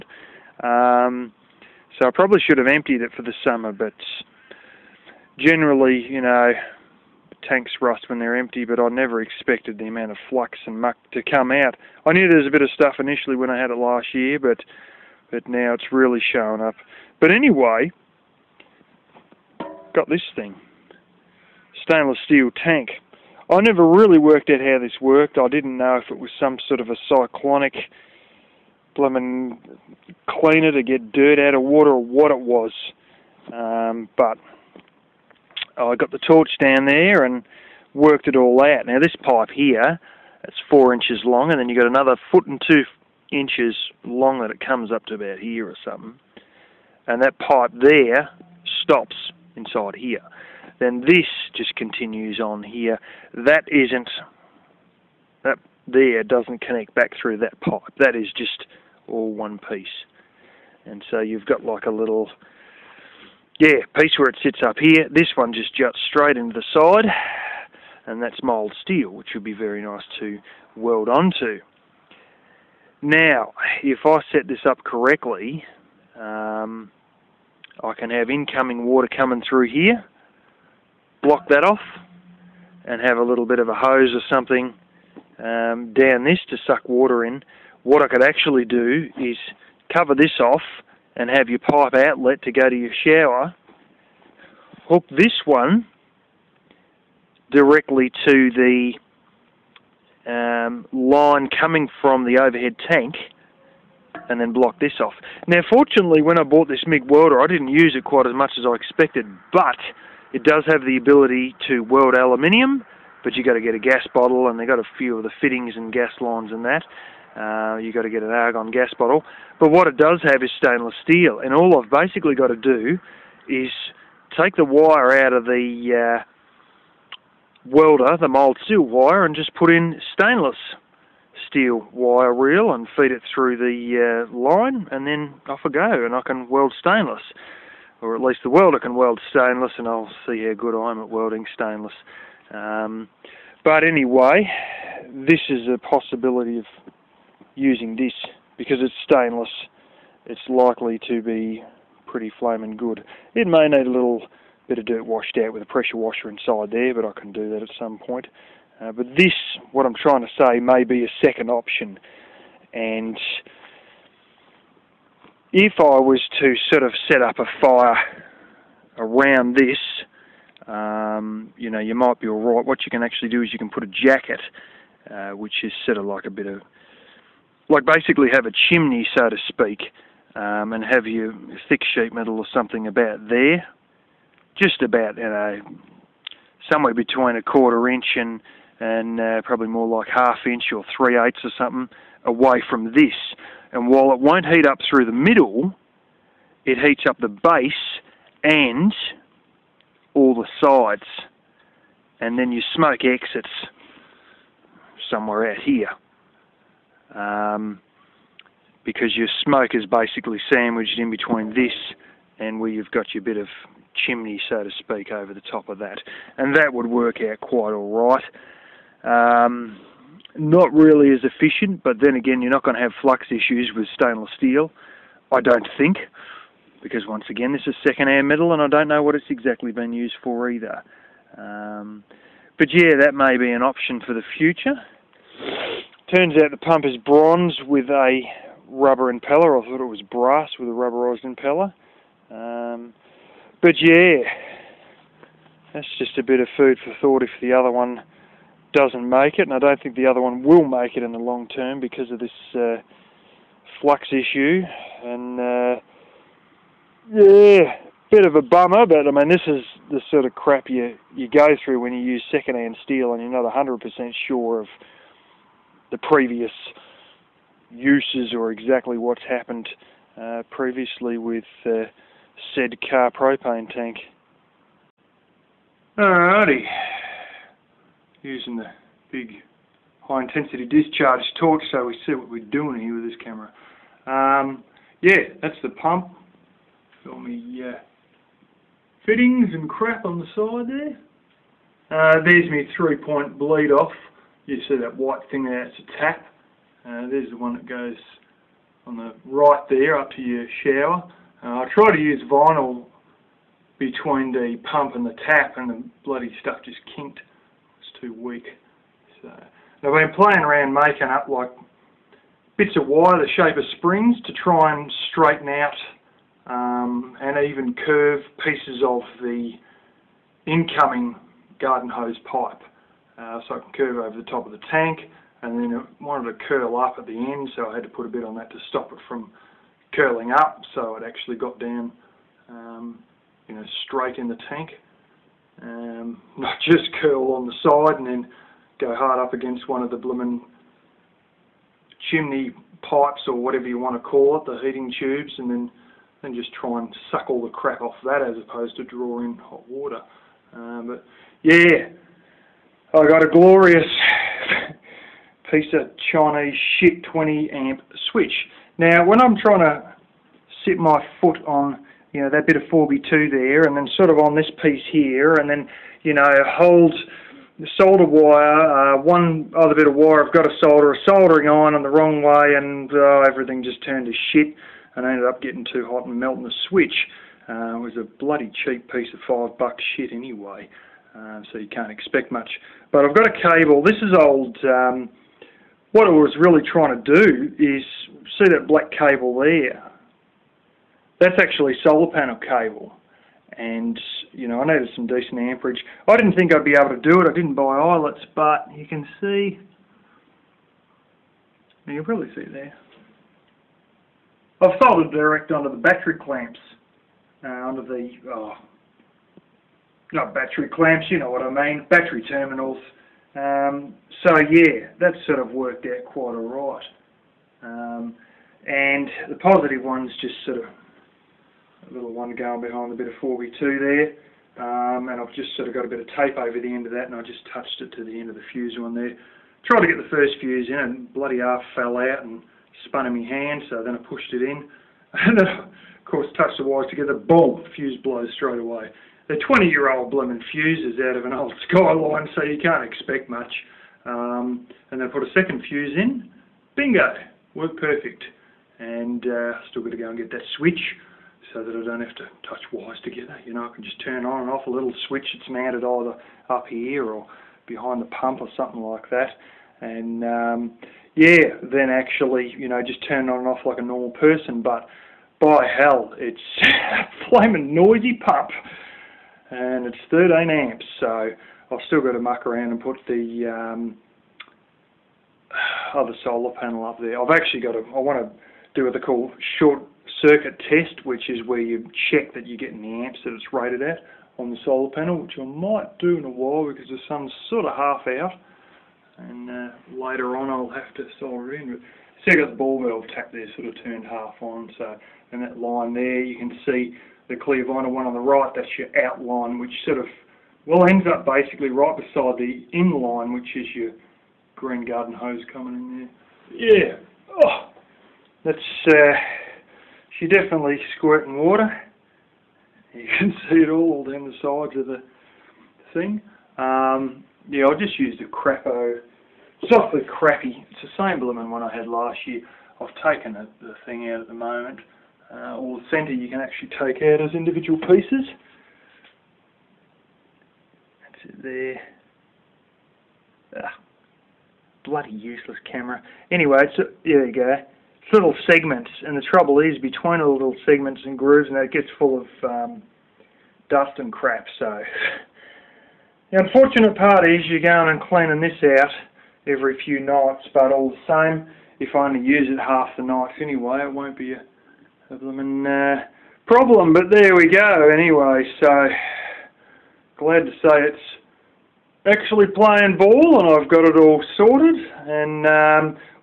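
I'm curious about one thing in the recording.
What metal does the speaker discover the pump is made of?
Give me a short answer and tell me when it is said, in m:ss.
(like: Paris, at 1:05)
bronze, at 3:57.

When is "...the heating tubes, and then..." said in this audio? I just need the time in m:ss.
5:44.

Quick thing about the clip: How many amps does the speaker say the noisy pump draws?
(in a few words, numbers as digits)
13 amps.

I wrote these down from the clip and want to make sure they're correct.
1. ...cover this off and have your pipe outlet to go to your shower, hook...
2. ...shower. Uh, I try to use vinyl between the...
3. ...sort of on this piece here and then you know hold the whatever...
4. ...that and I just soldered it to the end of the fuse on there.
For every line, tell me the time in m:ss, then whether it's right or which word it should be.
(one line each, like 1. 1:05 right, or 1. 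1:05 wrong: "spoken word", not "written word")
1. 1:29 right
2. 5:00 right
3. 6:03 wrong: "solder", not "whatever"
4. 7:06 wrong: "touched", not "soldered".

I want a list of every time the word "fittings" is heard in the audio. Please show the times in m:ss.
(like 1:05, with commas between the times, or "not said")
1:55, 4:49.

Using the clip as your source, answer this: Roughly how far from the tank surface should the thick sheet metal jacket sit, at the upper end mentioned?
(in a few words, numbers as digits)
half inch.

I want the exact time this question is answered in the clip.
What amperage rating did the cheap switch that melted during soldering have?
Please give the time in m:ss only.
5:57.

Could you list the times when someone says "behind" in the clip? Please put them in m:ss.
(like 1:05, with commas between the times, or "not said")
7:02, 7:37.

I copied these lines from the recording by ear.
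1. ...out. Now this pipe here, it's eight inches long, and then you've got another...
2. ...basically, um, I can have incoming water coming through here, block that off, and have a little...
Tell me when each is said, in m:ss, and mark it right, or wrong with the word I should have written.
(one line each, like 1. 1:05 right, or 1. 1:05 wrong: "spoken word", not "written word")
1. 0:38 wrong: "four", not "eight"
2. 1:14 wrong: "correctly", not "basically".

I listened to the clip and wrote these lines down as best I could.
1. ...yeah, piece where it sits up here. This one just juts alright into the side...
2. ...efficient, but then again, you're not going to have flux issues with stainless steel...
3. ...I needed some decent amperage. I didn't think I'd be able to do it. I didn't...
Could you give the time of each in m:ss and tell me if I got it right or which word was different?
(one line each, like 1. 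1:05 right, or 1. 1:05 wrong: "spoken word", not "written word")
1. 1:03 wrong: "straight", not "alright"
2. 3:41 right
3. 6:34 right.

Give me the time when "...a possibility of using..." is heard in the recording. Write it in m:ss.
2:25.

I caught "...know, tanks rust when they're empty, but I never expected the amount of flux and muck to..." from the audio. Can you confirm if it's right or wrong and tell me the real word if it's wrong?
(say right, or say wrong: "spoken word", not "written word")
right.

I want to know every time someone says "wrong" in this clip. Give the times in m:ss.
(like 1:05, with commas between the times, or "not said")
6:11.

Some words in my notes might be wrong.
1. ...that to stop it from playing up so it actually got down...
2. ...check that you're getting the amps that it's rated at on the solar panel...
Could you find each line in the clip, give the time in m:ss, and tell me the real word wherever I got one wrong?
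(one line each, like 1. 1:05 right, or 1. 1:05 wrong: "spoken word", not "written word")
1. 5:28 wrong: "curling", not "playing"
2. 8:02 right.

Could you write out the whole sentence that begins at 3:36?
And that would work out quite all right.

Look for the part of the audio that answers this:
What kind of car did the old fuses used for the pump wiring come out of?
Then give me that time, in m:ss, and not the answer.
7:21.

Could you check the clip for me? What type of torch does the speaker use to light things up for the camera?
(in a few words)
high intensity discharge.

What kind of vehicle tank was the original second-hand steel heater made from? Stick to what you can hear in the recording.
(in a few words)
car propane tank.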